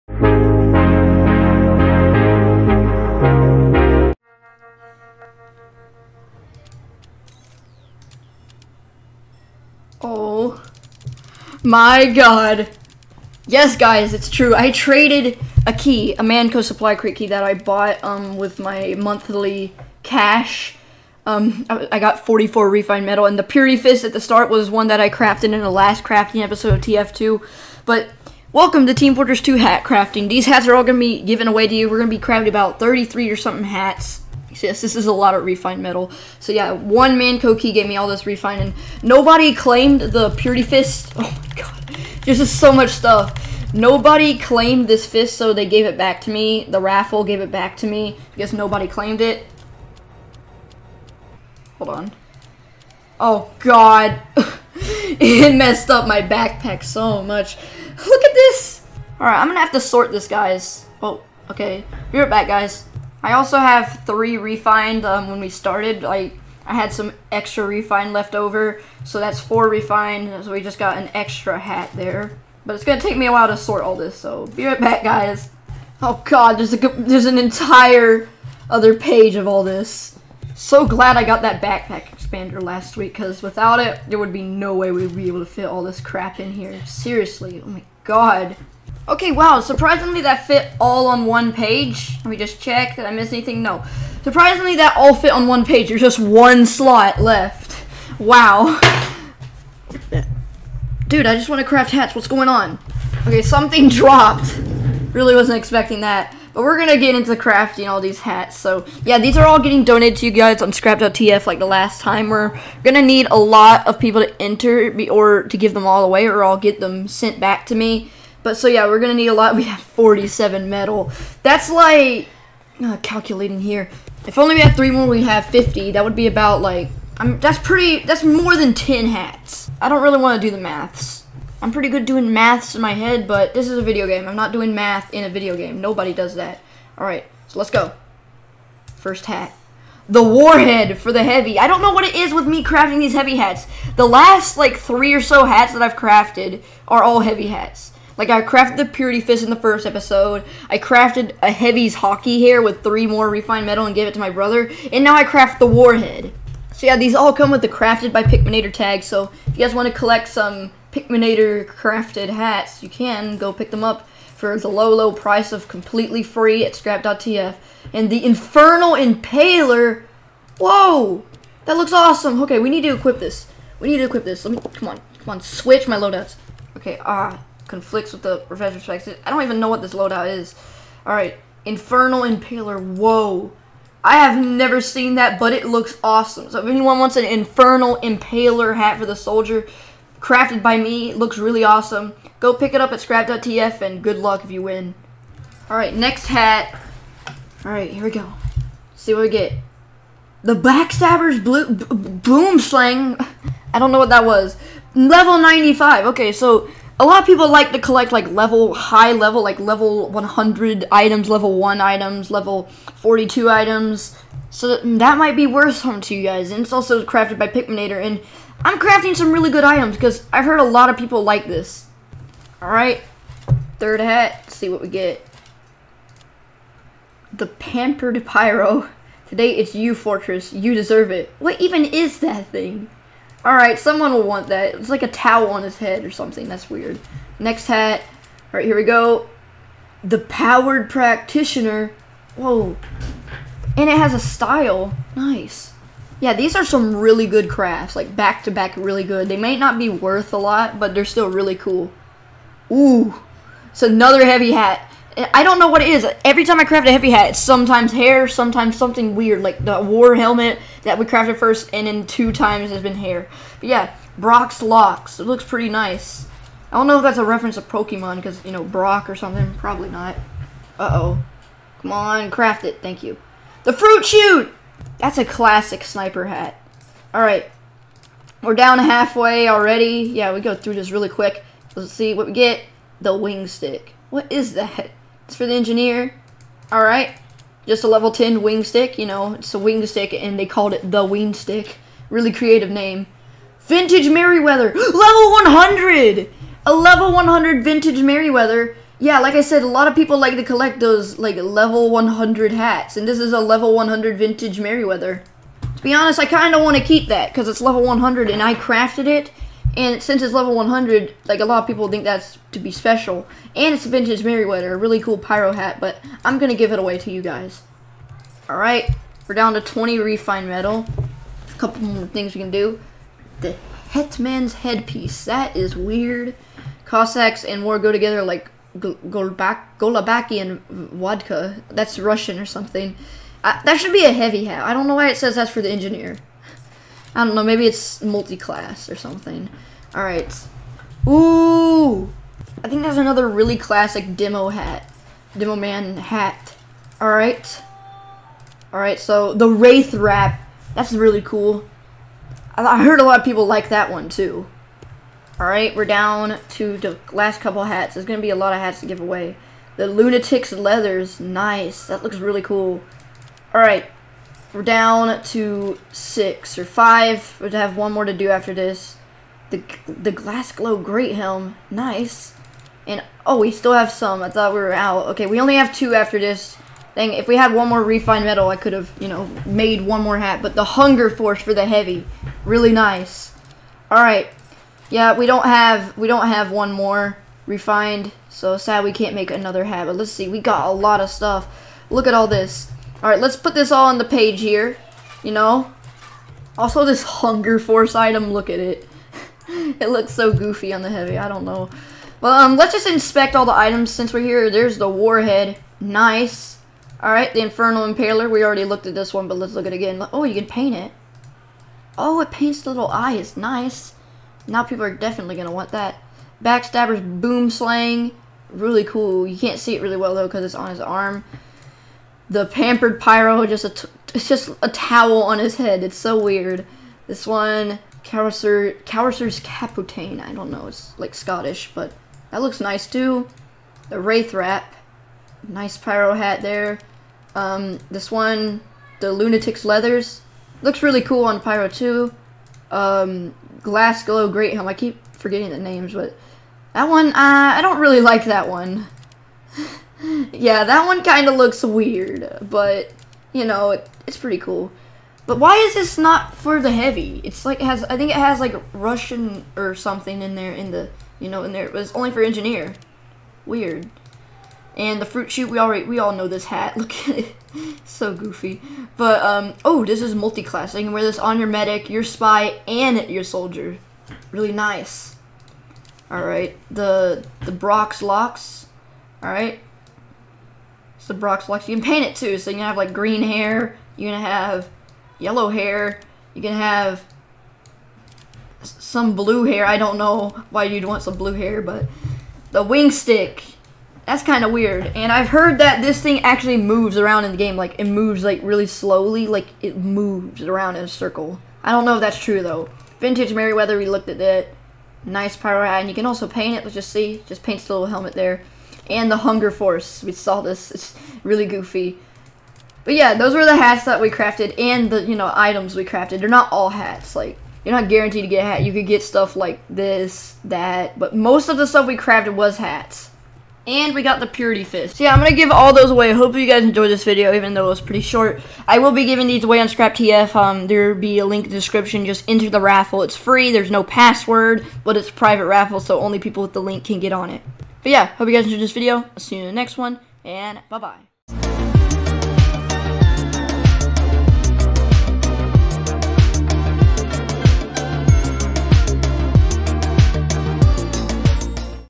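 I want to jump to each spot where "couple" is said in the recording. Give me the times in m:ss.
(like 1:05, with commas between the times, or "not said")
5:21, 5:57.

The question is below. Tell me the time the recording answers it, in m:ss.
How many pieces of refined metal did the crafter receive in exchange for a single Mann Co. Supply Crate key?
0:22.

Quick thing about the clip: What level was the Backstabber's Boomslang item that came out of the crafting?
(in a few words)
95.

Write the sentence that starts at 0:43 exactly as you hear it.
Nobody claimed this fist, so they gave it back to me.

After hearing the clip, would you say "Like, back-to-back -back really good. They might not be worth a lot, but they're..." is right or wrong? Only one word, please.
right.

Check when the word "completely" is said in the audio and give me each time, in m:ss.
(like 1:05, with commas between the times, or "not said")
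2:45.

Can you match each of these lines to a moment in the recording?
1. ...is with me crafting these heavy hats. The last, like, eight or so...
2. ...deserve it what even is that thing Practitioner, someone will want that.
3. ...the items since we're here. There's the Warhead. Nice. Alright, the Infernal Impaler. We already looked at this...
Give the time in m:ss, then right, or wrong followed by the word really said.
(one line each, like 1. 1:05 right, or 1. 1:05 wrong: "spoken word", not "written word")
1. 2:22 wrong: "three", not "eight"
2. 3:50 wrong: "Alright", not "Practitioner"
3. 6:43 right.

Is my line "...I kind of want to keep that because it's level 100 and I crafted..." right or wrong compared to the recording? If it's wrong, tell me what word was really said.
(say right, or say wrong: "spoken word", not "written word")
right.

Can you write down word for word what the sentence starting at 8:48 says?
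I will be giving these away on Scrap TF.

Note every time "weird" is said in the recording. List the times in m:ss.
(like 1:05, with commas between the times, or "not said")
3:56, 4:19, 5:25, 7:06, 7:31, 7:43, 8:14.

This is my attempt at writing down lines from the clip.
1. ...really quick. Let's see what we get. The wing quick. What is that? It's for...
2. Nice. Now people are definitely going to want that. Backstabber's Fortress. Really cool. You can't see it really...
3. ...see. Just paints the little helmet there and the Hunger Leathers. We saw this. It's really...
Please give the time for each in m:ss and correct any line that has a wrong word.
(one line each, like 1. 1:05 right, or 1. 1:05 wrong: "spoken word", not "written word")
1. 4:40 wrong: "stick", not "quick"
2. 6:53 wrong: "Boomslang", not "Fortress"
3. 8:26 wrong: "Force", not "Leathers".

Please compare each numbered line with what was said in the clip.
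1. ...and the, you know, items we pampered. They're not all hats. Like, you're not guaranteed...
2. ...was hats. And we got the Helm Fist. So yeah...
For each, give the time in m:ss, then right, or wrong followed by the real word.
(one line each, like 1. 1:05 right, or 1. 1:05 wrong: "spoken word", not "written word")
1. 8:34 wrong: "crafted", not "pampered"
2. 8:42 wrong: "Purity", not "Helm".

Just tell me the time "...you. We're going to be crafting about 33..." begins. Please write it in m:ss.
0:31.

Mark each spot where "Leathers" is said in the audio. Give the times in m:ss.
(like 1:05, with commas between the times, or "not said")
6:00, 7:19.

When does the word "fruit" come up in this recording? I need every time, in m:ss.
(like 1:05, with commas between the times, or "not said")
4:33, 7:45.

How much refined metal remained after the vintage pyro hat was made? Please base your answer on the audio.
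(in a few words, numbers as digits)
20.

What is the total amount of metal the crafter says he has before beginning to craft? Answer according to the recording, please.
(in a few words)
47.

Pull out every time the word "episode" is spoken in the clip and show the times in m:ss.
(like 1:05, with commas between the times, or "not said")
0:26, 2:29.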